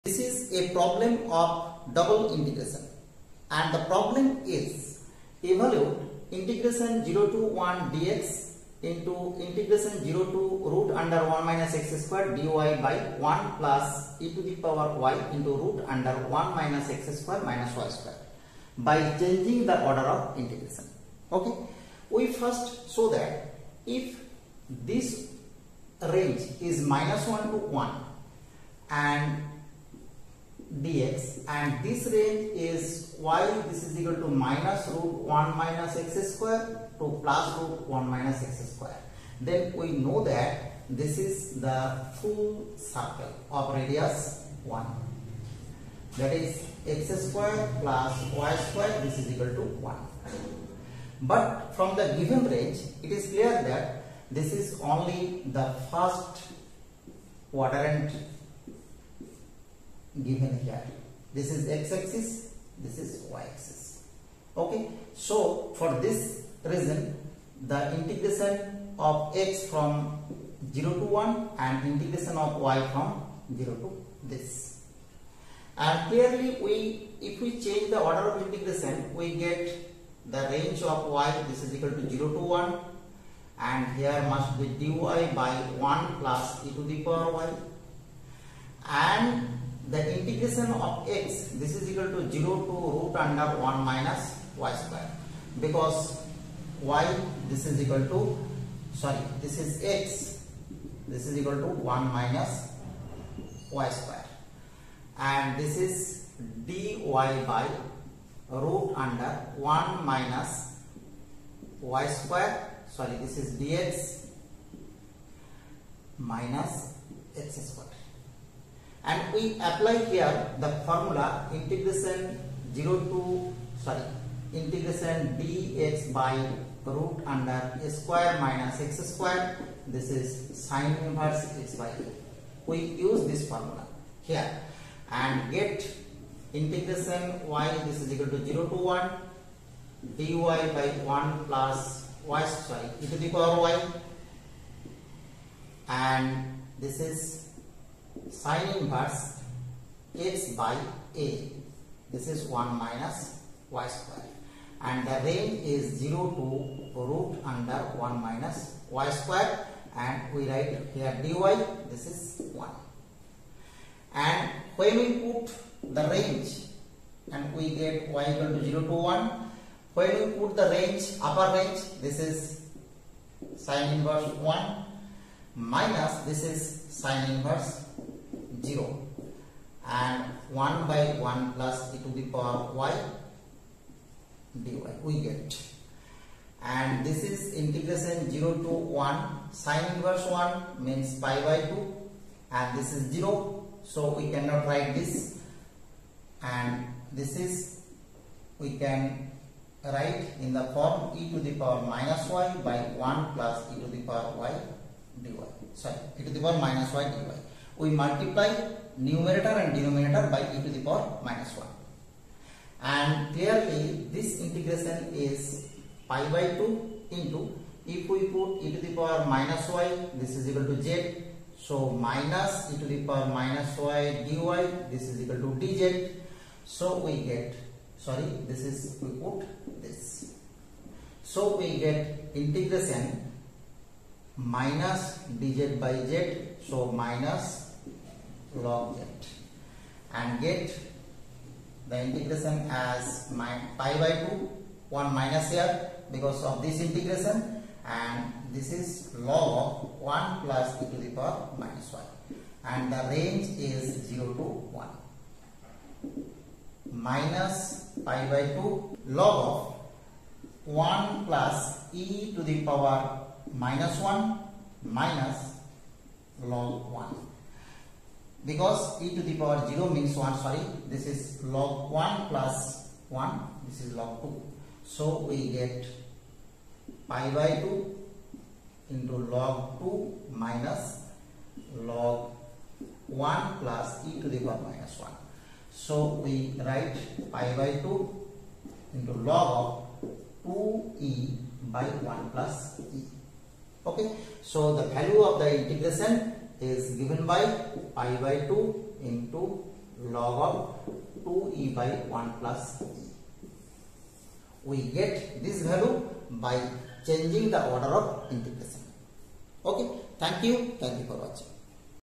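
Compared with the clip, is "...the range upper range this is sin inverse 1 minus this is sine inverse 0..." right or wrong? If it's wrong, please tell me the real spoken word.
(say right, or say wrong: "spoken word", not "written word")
right.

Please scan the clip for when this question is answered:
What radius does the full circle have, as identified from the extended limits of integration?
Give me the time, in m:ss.
0:42.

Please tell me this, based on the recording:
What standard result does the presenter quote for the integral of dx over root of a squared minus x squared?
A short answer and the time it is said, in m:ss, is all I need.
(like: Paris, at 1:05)
sin inverse x by a, at 2:10.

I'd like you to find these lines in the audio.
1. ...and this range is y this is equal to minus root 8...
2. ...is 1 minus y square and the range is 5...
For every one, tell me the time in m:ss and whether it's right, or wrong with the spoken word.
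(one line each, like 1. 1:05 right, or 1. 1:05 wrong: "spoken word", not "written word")
1. 0:31 wrong: "1", not "8"
2. 2:32 wrong: "0", not "5".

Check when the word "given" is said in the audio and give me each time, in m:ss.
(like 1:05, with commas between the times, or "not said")
0:52, 1:00, 4:56.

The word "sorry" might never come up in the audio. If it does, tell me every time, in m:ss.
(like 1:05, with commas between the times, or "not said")
1:39, 1:52, 2:03, 2:22, 3:25, 3:48, 4:30.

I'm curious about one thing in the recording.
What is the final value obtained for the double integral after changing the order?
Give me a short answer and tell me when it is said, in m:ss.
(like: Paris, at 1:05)
pi/2 log(2e/(1+e)), at 4:57.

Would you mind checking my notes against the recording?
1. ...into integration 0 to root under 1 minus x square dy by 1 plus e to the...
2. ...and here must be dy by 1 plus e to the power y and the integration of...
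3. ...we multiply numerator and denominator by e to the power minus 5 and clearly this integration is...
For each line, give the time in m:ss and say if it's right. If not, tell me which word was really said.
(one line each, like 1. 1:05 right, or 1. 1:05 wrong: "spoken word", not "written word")
1. 0:08 right
2. 1:23 right
3. 3:27 wrong: "1", not "5".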